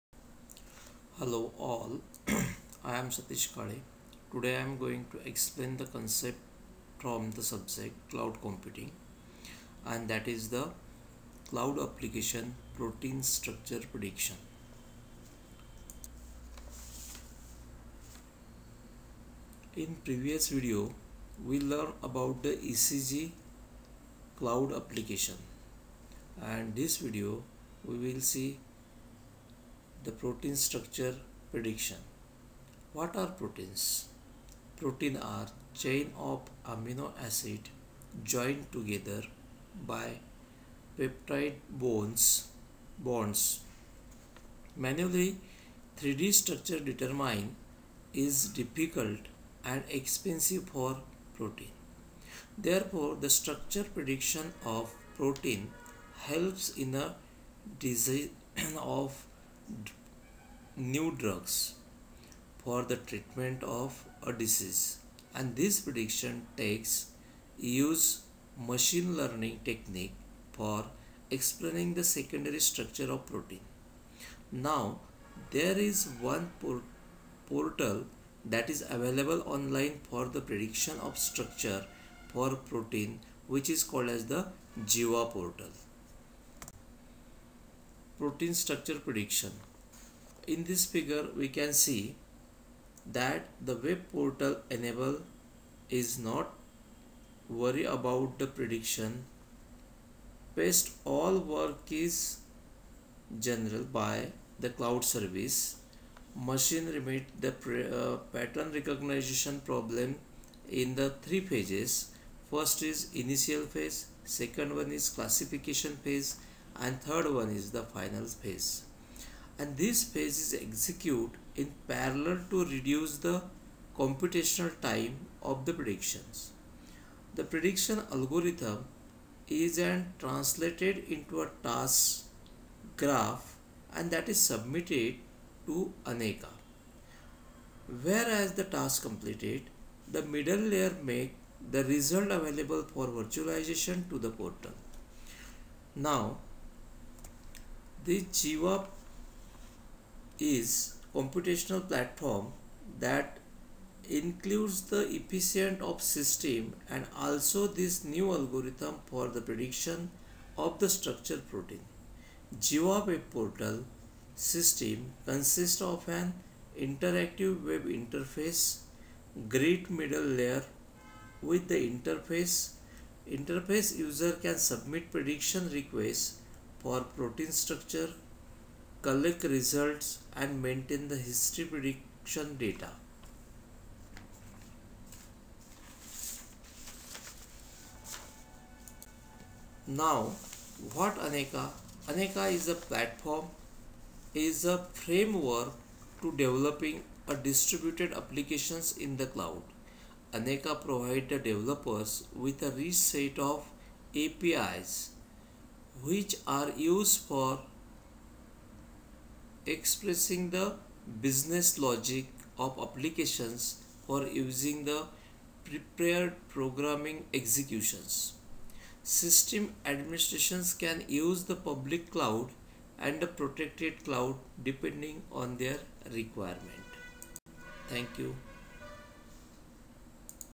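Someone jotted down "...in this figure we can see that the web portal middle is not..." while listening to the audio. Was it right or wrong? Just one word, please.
wrong.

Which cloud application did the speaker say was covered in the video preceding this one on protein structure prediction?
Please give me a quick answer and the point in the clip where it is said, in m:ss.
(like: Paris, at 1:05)
ECG, at 0:22.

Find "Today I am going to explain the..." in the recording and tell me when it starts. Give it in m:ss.
0:04.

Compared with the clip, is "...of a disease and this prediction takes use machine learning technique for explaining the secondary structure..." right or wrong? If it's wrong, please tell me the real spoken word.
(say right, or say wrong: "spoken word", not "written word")
right.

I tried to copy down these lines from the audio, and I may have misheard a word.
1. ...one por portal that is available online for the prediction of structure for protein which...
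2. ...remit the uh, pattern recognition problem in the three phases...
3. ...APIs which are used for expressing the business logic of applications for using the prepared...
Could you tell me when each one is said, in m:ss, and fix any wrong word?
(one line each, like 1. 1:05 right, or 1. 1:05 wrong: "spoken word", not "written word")
1. 1:16 right
2. 1:46 right
3. 3:24 right.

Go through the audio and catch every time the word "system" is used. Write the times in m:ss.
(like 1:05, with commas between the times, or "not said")
2:36, 2:44, 3:39.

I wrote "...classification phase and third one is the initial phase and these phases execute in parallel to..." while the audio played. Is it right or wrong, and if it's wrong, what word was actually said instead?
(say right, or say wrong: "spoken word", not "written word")
wrong: "final", not "initial".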